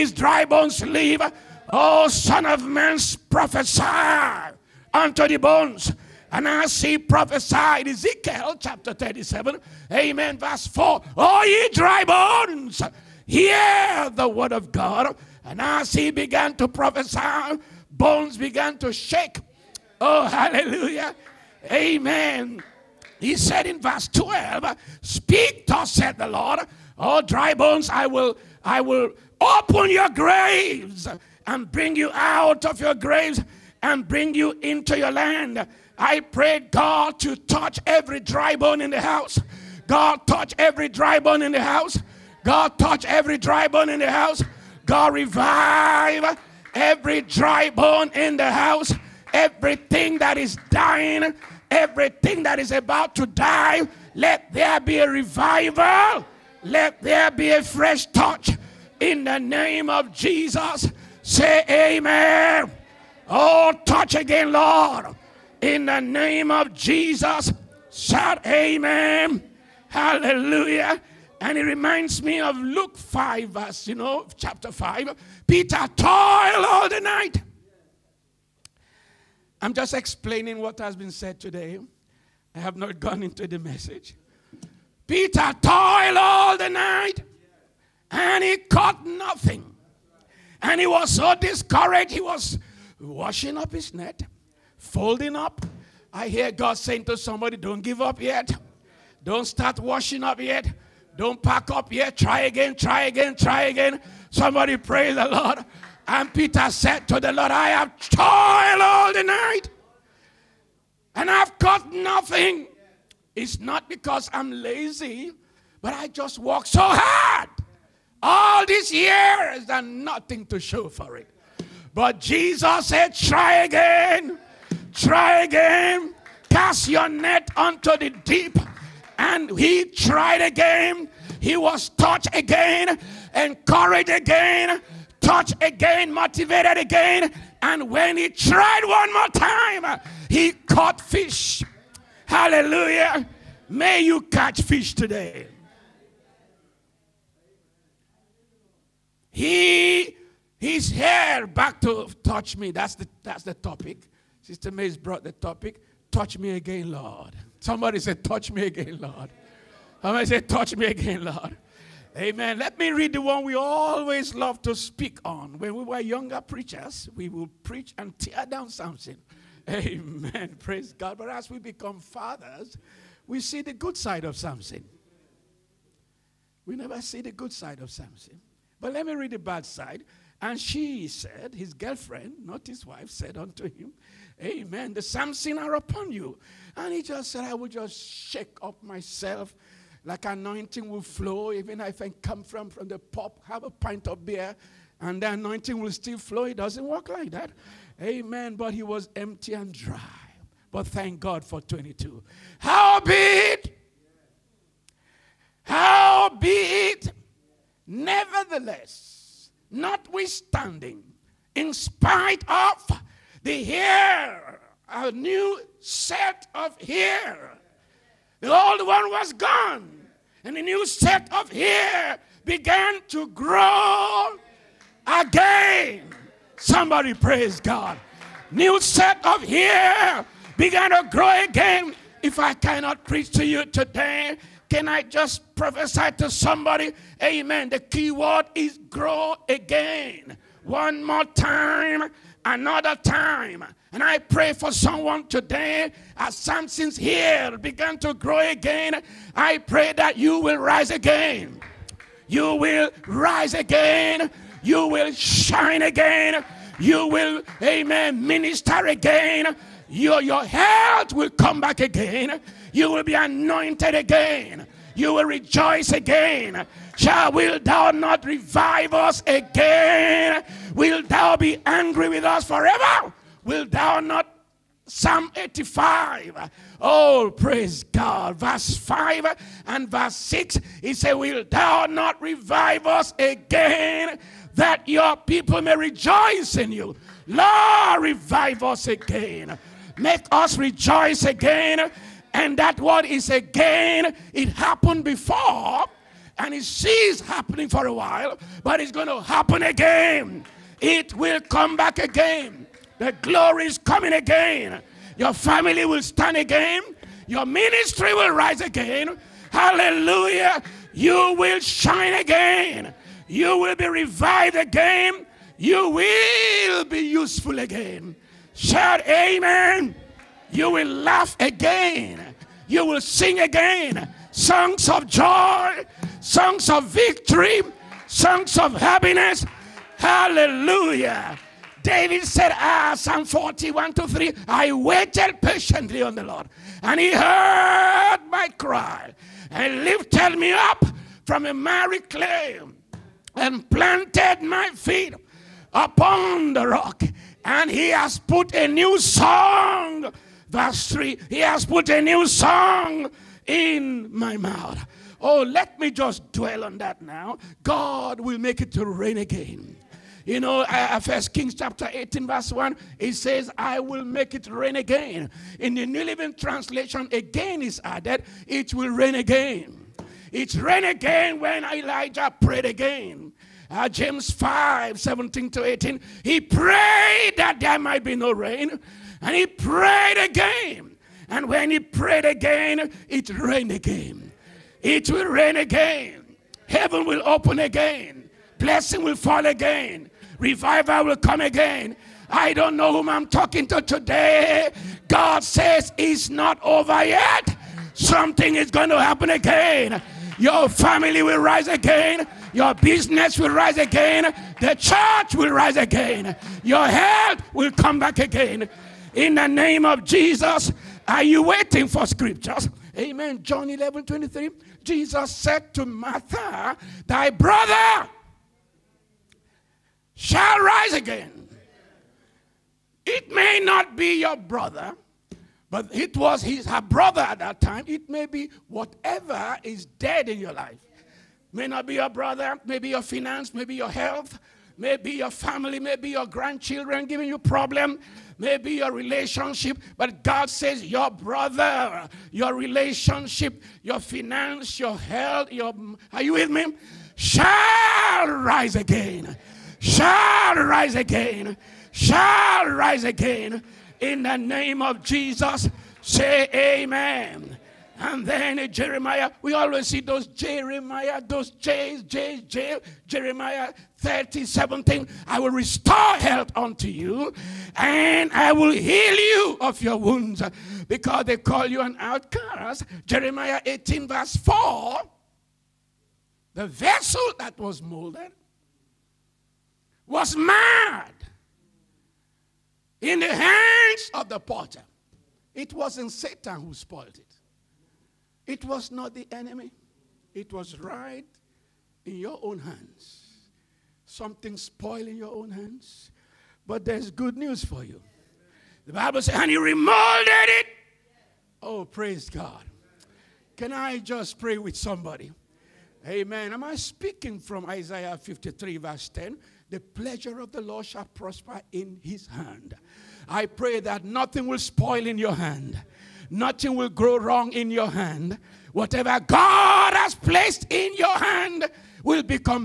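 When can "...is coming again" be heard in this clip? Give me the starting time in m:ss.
5:03.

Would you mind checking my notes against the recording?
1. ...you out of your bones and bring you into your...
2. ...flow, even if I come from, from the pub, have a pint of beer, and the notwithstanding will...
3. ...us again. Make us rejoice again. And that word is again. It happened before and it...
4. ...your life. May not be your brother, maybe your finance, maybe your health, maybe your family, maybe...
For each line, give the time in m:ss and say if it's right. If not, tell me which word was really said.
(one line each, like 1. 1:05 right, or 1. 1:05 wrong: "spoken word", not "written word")
1. 0:31 wrong: "graves", not "bones"
2. 3:11 wrong: "anointing", not "notwithstanding"
3. 4:48 right
4. 7:10 right.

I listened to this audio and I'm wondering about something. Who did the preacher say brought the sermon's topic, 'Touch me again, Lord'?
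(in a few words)
Sister Mays.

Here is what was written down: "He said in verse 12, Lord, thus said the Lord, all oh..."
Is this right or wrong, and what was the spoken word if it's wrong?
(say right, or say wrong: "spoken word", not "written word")
wrong: "Speak", not "Lord".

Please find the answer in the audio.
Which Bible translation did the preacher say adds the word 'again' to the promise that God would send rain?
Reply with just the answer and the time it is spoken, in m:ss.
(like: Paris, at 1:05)
New Living Translation, at 6:05.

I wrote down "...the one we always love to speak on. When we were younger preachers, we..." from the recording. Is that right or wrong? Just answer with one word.
right.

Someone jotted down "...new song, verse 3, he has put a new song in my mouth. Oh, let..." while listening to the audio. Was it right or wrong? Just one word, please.
right.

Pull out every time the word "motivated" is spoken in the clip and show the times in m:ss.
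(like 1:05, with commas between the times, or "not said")
2:16.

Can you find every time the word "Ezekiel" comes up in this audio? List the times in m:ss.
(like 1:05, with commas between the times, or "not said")
0:07.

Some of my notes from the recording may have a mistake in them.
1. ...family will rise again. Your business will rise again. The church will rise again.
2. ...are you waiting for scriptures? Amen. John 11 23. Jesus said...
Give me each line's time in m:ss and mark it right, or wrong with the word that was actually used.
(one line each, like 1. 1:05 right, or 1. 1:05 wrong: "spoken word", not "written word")
1. 6:40 right
2. 6:51 right.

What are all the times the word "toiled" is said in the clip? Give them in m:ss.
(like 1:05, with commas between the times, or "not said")
1:15, 1:25, 1:48.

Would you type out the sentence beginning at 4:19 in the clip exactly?
Your, your health will come back again.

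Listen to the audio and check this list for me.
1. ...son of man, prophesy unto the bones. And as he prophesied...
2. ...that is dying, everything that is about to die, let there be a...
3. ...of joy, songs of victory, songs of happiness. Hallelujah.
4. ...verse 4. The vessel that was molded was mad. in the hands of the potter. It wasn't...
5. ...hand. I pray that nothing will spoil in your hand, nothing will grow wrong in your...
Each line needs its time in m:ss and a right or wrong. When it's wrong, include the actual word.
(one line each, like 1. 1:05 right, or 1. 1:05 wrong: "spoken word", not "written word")
1. 0:02 right
2. 0:50 right
3. 5:24 right
4. 7:54 right
5. 8:32 right.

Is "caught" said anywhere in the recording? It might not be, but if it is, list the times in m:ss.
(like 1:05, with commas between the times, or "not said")
1:28, 1:51, 2:20.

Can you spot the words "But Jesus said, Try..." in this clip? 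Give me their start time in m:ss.
2:01.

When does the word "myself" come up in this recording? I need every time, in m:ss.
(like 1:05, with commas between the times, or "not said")
3:08.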